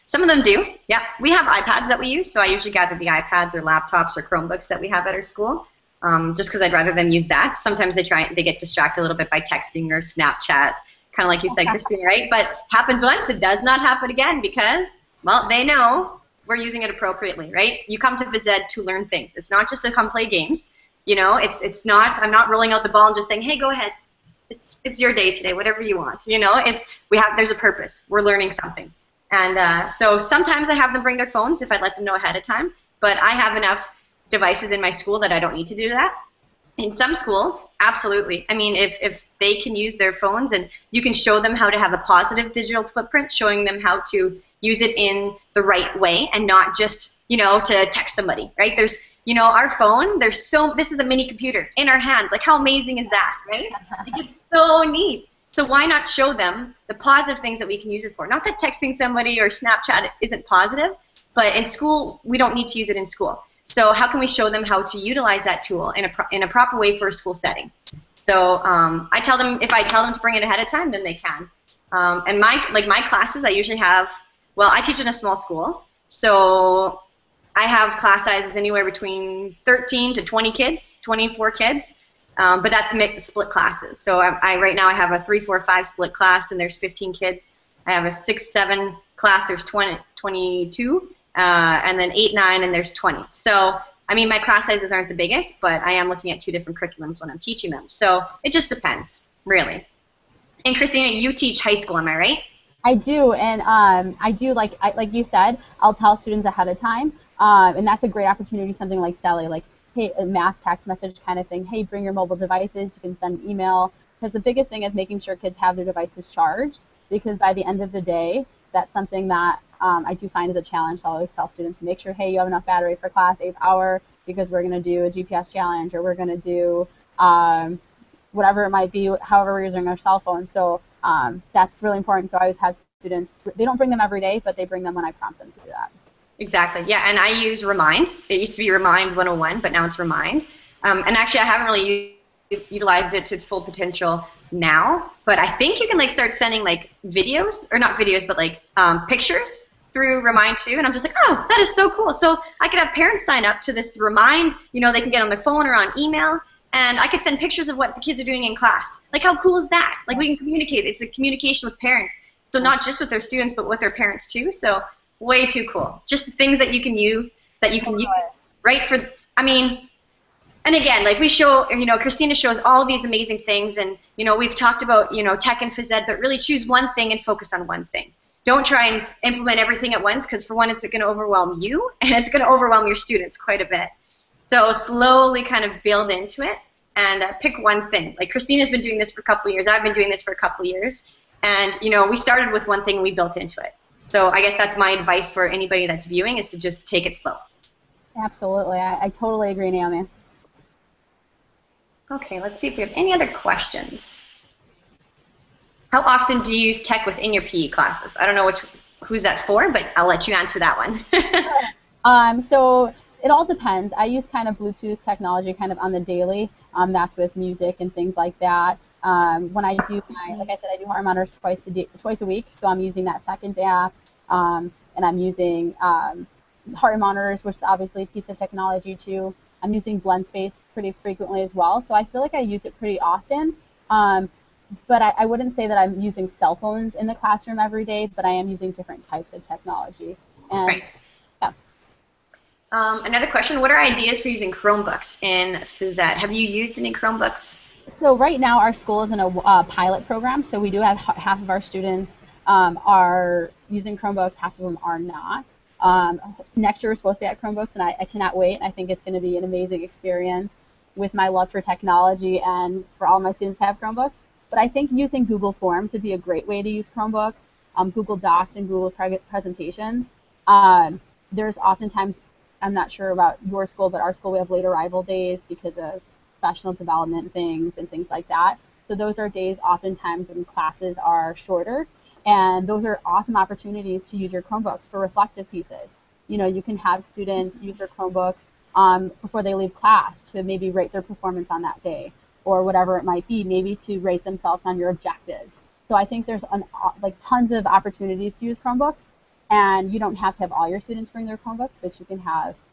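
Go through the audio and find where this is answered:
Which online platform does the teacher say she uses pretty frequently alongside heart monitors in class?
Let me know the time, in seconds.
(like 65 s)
229 s.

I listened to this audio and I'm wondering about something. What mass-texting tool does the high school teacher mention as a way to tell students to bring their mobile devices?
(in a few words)
Celly.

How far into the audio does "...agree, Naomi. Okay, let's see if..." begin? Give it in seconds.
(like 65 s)
199 s.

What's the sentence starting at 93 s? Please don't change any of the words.
So I mean, my class sizes aren't the biggest, but I am looking at two different curriculums when I'm teaching them.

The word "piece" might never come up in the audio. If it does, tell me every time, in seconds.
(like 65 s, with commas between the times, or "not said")
228 s, 285 s.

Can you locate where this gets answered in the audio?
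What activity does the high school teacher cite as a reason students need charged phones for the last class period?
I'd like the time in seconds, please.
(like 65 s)
125 s.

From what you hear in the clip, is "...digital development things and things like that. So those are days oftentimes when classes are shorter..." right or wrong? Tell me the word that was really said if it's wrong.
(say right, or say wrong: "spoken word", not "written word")
wrong: "professional", not "digital".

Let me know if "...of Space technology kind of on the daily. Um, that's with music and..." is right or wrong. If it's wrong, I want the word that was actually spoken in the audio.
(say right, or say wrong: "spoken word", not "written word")
wrong: "Bluetooth", not "Space".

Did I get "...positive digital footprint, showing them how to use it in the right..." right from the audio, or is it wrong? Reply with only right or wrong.
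right.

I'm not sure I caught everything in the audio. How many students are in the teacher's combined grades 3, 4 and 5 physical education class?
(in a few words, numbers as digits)
15.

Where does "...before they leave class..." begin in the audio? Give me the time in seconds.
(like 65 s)
289 s.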